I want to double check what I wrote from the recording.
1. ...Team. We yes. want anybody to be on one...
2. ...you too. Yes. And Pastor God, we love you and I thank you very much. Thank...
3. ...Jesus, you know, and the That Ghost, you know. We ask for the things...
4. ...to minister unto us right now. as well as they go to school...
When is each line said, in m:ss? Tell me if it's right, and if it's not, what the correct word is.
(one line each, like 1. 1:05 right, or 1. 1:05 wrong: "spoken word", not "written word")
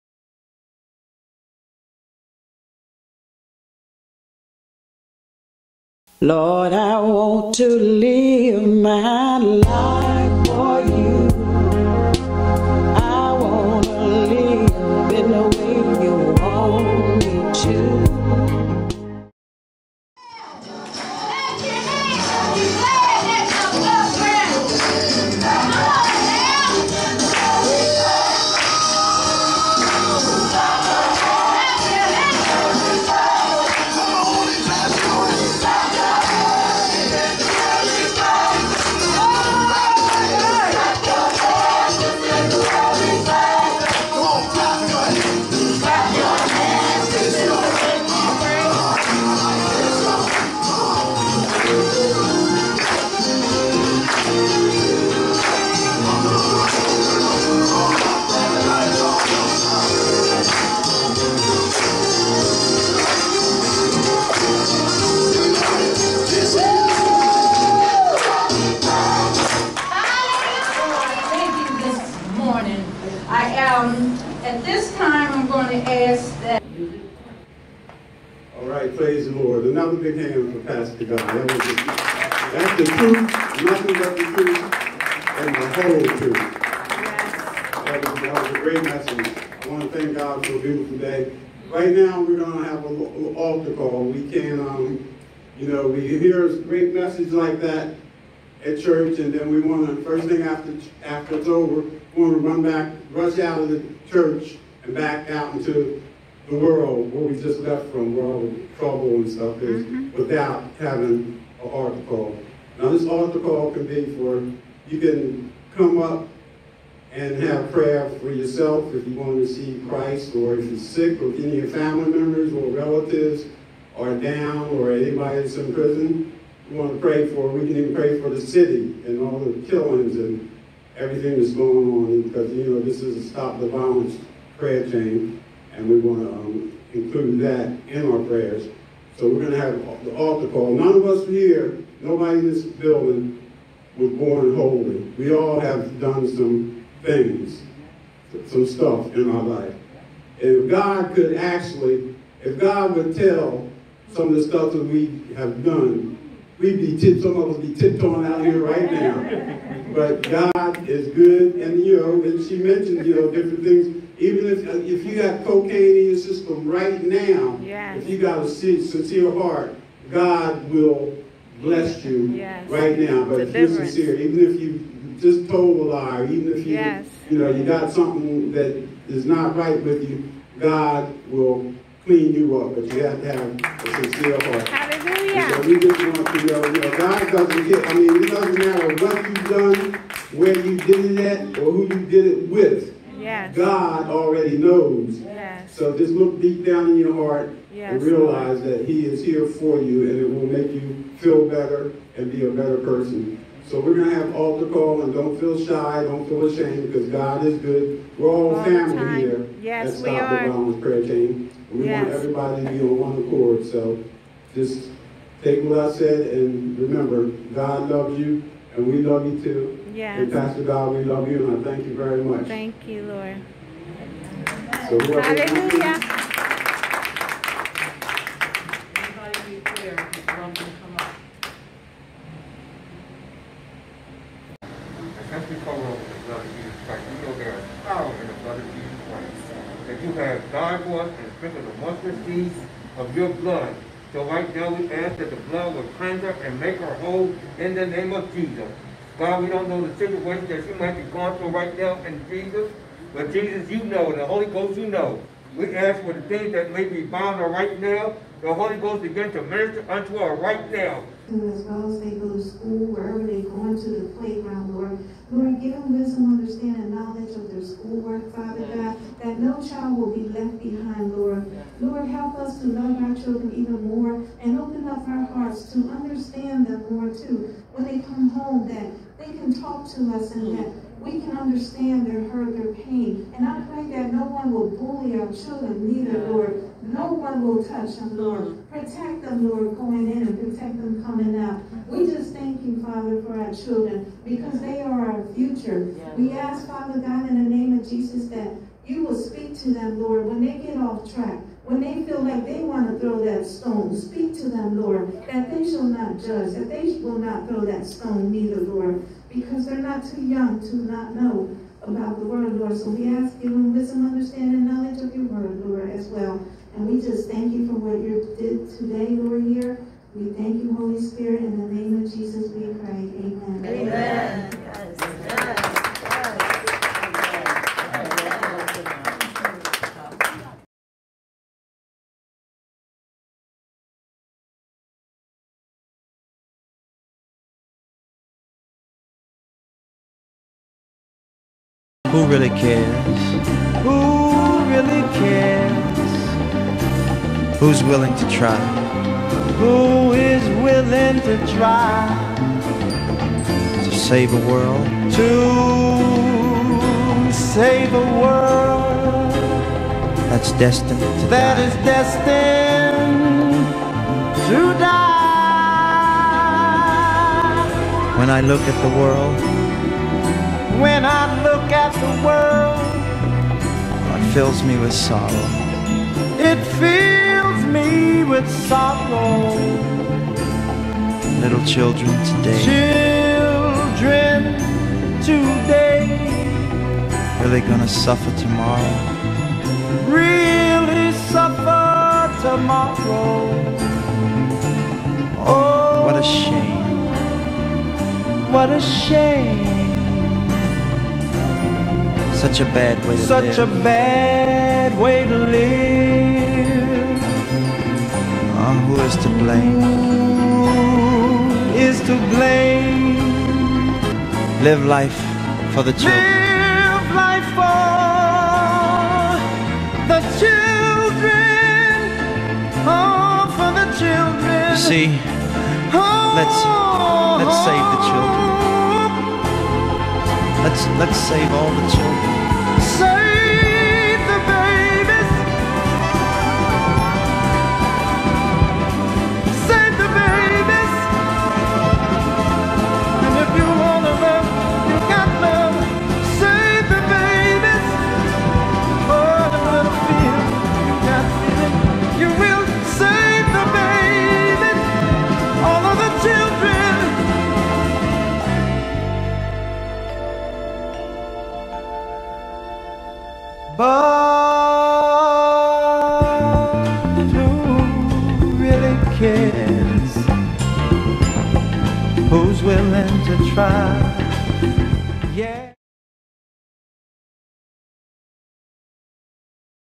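1. 3:31 wrong: "everybody", not "anybody"
2. 3:39 right
3. 4:13 wrong: "Holy", not "That"
4. 4:19 right.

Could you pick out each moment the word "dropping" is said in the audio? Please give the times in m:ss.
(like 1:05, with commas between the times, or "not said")
not said.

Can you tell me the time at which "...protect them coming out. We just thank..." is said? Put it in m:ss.
4:50.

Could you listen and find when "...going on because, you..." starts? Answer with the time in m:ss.
2:11.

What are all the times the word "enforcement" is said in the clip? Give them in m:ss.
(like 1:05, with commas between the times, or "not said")
not said.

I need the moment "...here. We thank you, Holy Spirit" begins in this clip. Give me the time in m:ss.
5:19.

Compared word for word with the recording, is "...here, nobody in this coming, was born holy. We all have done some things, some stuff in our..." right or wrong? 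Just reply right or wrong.
wrong.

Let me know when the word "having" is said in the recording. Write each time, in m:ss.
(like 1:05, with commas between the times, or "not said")
1:50.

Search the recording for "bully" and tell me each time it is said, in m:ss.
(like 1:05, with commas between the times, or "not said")
4:44.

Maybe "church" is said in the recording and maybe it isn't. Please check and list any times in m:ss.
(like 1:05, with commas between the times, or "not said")
1:38, 1:44.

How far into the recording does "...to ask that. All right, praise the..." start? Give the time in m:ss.
1:15.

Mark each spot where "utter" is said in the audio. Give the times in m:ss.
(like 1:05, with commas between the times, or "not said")
not said.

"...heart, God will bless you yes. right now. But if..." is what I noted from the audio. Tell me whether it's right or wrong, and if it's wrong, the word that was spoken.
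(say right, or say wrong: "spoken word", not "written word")
right.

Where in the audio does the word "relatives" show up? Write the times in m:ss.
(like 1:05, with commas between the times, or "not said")
2:02.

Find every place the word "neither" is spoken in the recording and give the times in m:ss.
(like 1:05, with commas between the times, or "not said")
4:45, 5:08.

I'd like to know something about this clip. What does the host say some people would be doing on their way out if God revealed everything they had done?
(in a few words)
tiptoeing.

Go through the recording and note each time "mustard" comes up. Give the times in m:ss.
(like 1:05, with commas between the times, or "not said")
4:01.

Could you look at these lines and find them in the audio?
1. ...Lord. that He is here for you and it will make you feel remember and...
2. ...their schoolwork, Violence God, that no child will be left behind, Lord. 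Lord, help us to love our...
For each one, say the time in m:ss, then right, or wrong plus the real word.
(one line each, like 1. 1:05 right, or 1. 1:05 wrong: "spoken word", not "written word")
1. 3:18 wrong: "better", not "remember"
2. 4:27 wrong: "Father", not "Violence".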